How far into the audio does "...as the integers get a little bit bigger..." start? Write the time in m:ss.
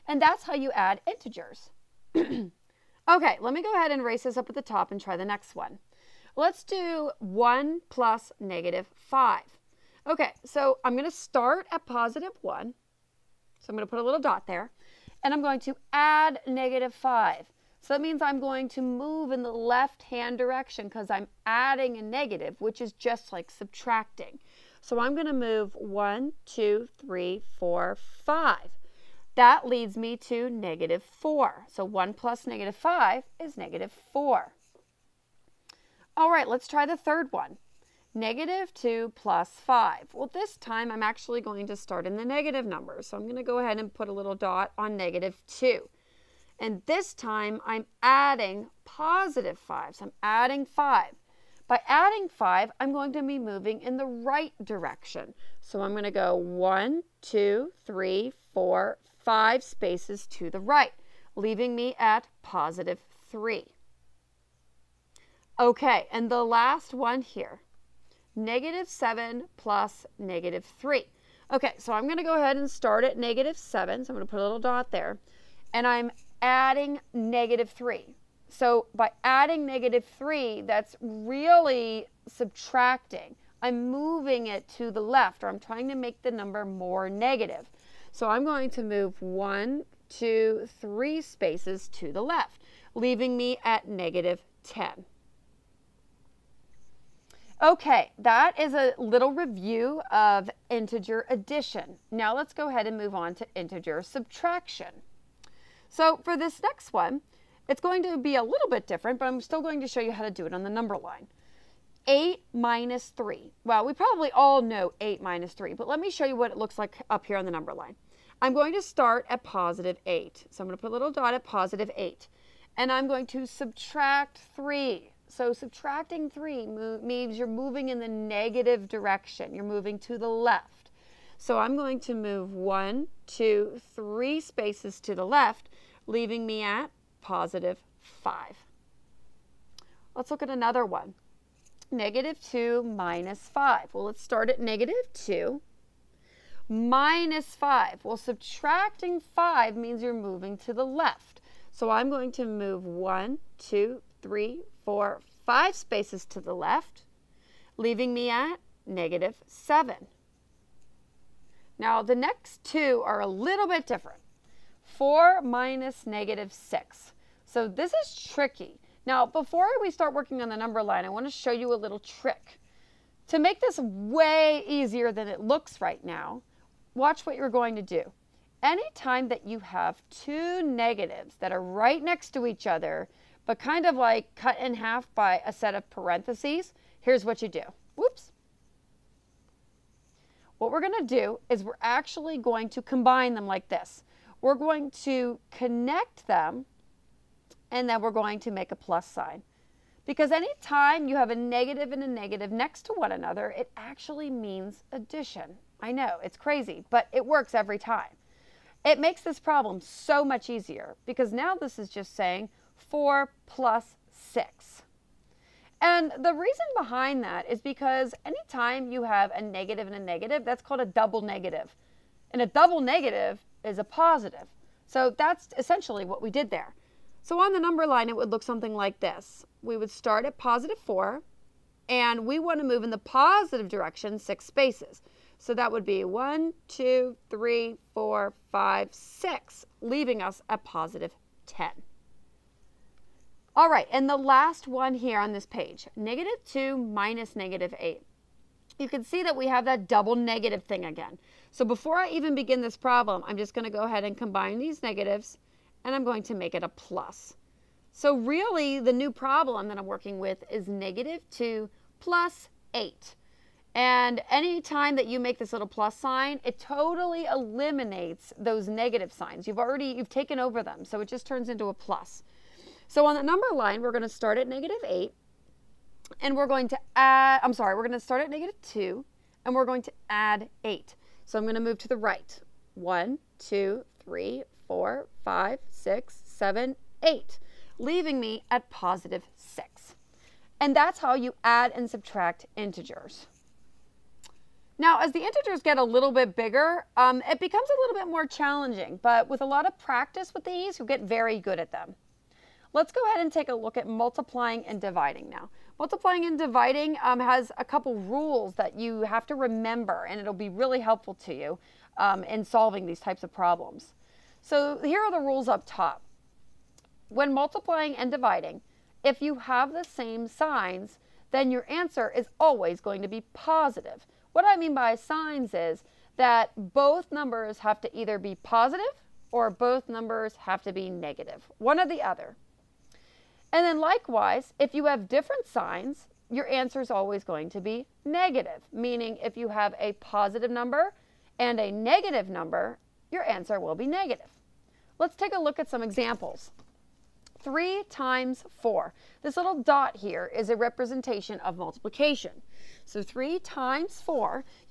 4:54.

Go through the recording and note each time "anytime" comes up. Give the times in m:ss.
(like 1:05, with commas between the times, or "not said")
2:58, 3:20, 3:38.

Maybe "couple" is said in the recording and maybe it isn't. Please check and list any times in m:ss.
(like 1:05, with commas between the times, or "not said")
5:07.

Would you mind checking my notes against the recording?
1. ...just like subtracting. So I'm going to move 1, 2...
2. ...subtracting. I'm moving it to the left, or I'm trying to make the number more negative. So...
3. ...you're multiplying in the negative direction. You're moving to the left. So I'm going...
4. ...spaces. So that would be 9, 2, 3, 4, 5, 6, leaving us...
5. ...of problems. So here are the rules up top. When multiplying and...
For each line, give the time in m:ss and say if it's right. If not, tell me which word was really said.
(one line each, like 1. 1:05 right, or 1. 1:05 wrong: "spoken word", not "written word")
1. 0:22 right
2. 1:22 right
3. 2:07 wrong: "moving", not "multiplying"
4. 3:54 wrong: "1", not "9"
5. 5:13 right.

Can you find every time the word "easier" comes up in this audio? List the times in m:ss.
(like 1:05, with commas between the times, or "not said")
2:54, 3:30.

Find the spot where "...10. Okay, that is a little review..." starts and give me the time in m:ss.
1:34.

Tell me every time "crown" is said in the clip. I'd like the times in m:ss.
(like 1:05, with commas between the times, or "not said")
not said.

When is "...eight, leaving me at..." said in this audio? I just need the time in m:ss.
4:47.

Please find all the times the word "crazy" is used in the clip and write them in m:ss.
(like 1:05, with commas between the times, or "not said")
3:26.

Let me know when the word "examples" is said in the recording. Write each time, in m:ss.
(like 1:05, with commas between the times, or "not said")
5:45.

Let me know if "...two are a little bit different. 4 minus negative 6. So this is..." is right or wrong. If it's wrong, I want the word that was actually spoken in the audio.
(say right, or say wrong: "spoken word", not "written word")
right.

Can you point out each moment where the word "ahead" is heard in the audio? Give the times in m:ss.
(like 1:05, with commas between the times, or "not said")
0:03, 0:43, 1:12, 1:42, 4:13, 5:03.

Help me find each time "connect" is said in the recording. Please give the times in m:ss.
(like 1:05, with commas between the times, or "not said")
3:15.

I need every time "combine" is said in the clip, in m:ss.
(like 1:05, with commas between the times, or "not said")
3:12, 4:14.